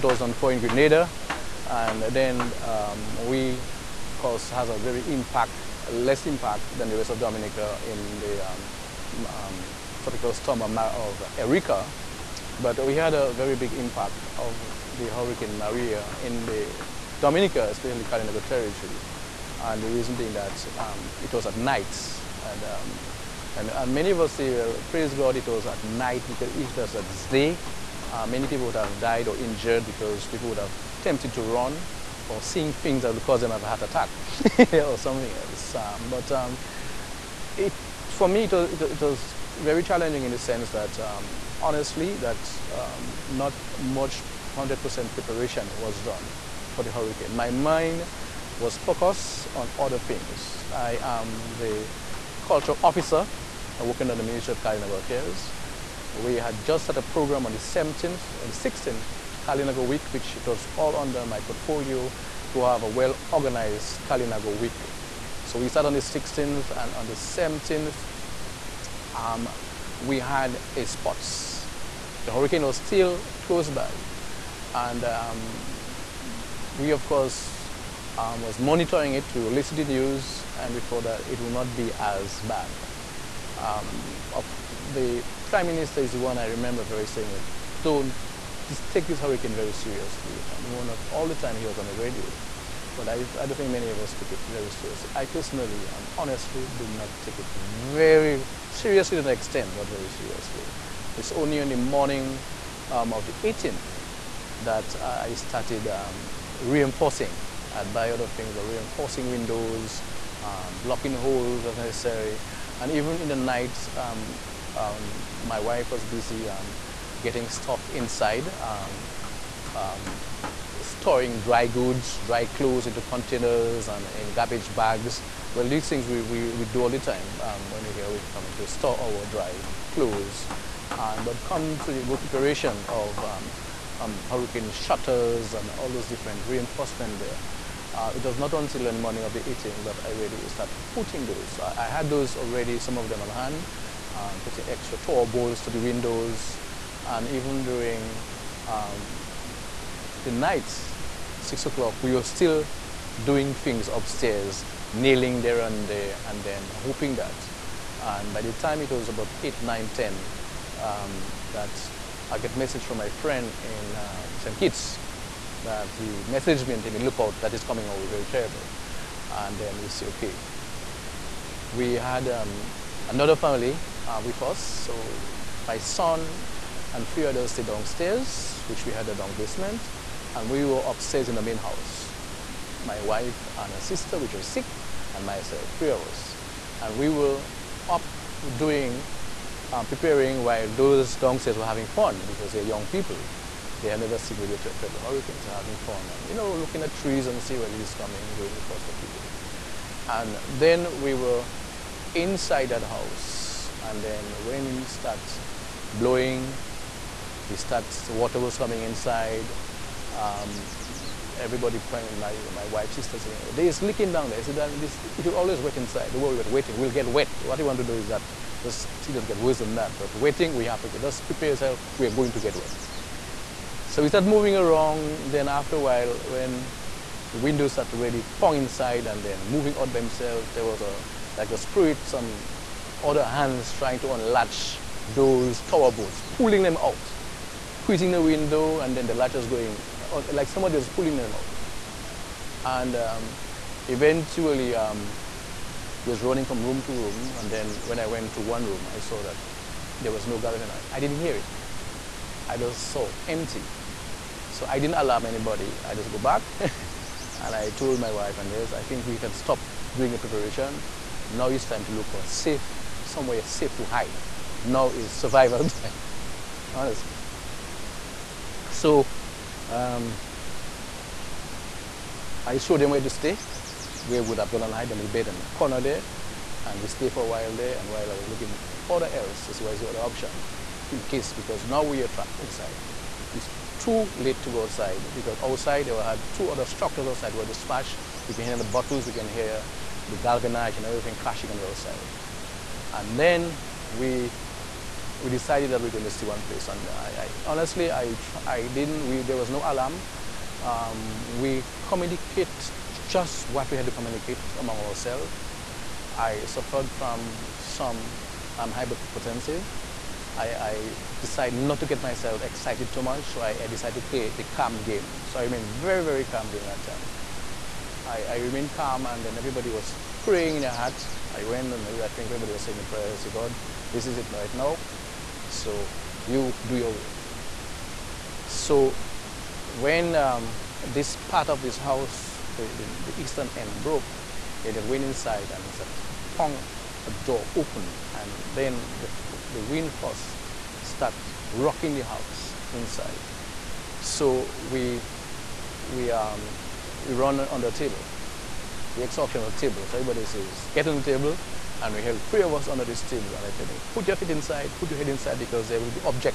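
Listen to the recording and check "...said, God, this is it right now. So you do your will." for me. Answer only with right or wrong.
right.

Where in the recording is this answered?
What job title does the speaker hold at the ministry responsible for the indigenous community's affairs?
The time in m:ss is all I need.
0:52.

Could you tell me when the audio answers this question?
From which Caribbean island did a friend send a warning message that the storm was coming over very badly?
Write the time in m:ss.
2:44.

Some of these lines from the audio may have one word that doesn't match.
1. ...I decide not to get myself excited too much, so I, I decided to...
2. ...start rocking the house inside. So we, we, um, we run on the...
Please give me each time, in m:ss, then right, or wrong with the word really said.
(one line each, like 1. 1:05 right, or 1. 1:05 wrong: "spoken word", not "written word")
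1. 5:10 right
2. 5:40 right.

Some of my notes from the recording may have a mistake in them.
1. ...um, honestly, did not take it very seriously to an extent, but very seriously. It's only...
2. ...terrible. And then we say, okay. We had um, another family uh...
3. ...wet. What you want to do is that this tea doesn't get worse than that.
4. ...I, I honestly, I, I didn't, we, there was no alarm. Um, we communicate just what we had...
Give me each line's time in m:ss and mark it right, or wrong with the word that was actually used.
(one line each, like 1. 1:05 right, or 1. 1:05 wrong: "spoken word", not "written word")
1. 1:35 right
2. 2:48 right
3. 3:37 right
4. 4:56 right.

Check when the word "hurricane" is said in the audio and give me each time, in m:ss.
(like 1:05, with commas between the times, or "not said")
0:15, 0:46, 1:12, 1:29, 2:14, 3:15.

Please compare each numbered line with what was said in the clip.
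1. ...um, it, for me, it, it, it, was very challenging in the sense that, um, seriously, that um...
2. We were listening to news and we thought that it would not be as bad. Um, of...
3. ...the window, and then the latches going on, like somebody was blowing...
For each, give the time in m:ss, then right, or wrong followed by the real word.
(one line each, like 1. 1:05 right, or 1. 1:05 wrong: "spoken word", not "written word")
1. 0:36 wrong: "honestly", not "seriously"
2. 1:19 right
3. 3:58 wrong: "pulling", not "blowing".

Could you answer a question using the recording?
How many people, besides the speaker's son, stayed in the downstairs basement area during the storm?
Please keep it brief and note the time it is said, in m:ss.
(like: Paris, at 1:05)
3, at 2:57.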